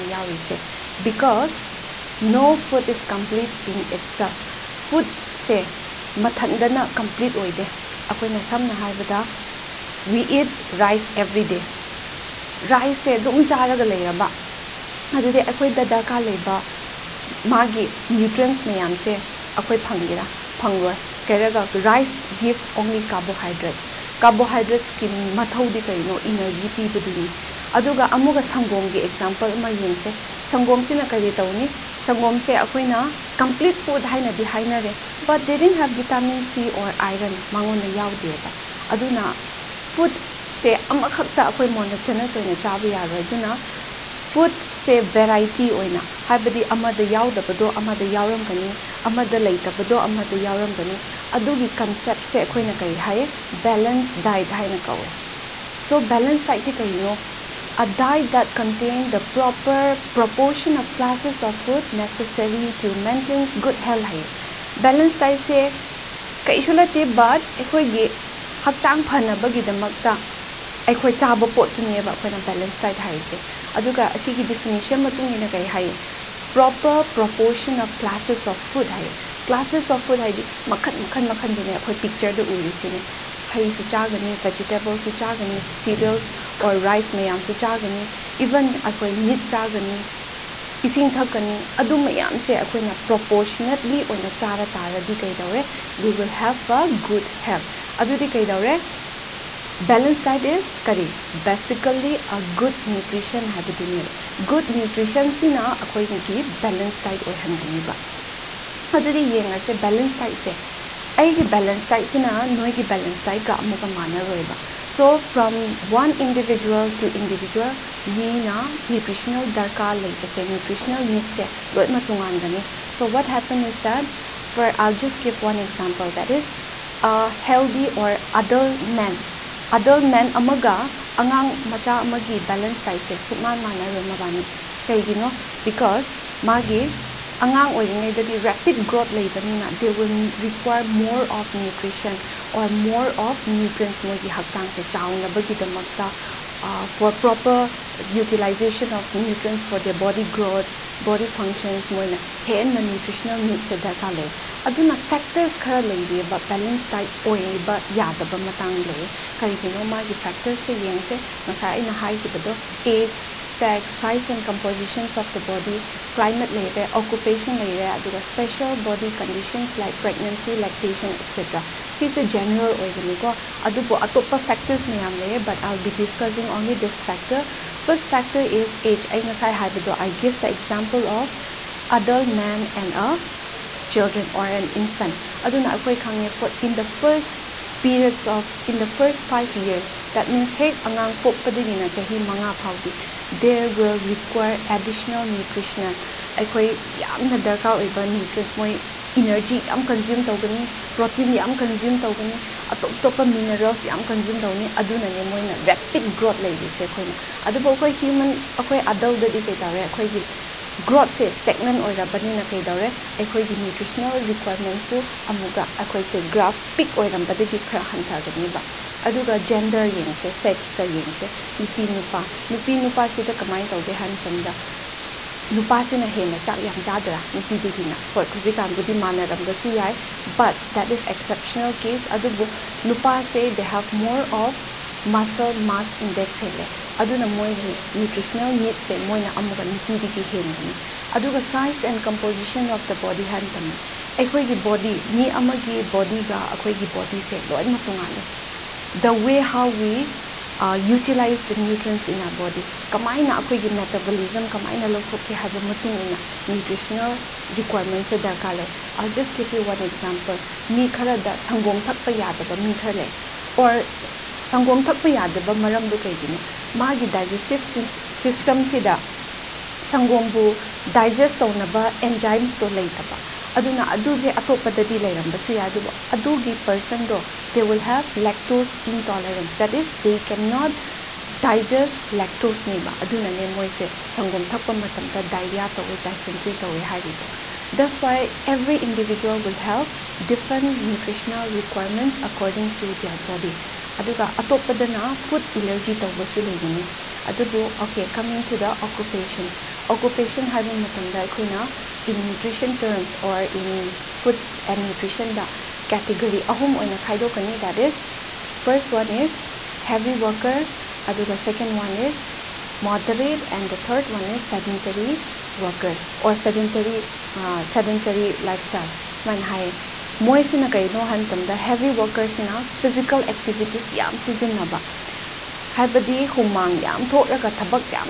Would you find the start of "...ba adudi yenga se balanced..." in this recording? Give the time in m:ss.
1:47.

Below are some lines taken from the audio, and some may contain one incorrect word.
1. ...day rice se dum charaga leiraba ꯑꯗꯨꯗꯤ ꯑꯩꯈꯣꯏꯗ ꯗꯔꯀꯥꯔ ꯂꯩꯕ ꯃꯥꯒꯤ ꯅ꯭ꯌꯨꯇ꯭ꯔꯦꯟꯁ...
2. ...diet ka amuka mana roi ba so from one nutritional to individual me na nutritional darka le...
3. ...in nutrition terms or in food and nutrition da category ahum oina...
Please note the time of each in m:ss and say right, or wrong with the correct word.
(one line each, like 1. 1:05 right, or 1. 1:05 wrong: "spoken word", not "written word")
1. 0:11 right
2. 1:53 wrong: "individual", not "nutritional"
3. 5:02 right.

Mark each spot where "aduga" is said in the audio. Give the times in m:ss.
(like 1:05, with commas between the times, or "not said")
3:39, 4:53, 5:11.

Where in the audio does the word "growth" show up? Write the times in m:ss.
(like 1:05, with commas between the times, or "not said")
2:18, 2:30, 3:26, 3:30.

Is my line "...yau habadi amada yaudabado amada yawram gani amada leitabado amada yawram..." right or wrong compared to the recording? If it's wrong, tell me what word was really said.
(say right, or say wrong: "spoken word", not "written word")
right.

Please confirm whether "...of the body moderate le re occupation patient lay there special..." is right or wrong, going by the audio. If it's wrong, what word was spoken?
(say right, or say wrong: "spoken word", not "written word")
wrong: "climate", not "moderate".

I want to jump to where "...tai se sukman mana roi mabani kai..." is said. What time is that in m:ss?
2:12.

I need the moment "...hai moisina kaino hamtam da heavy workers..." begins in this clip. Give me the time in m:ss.
5:19.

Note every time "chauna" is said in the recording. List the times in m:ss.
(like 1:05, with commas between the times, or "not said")
2:24.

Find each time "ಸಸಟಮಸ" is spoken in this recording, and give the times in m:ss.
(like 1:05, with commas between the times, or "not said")
4:28.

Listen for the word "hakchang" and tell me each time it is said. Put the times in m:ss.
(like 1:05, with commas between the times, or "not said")
1:08, 2:24.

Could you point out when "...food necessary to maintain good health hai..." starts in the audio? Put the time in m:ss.
1:01.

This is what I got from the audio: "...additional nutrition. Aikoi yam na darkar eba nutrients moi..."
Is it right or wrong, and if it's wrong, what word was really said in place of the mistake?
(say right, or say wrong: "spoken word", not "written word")
right.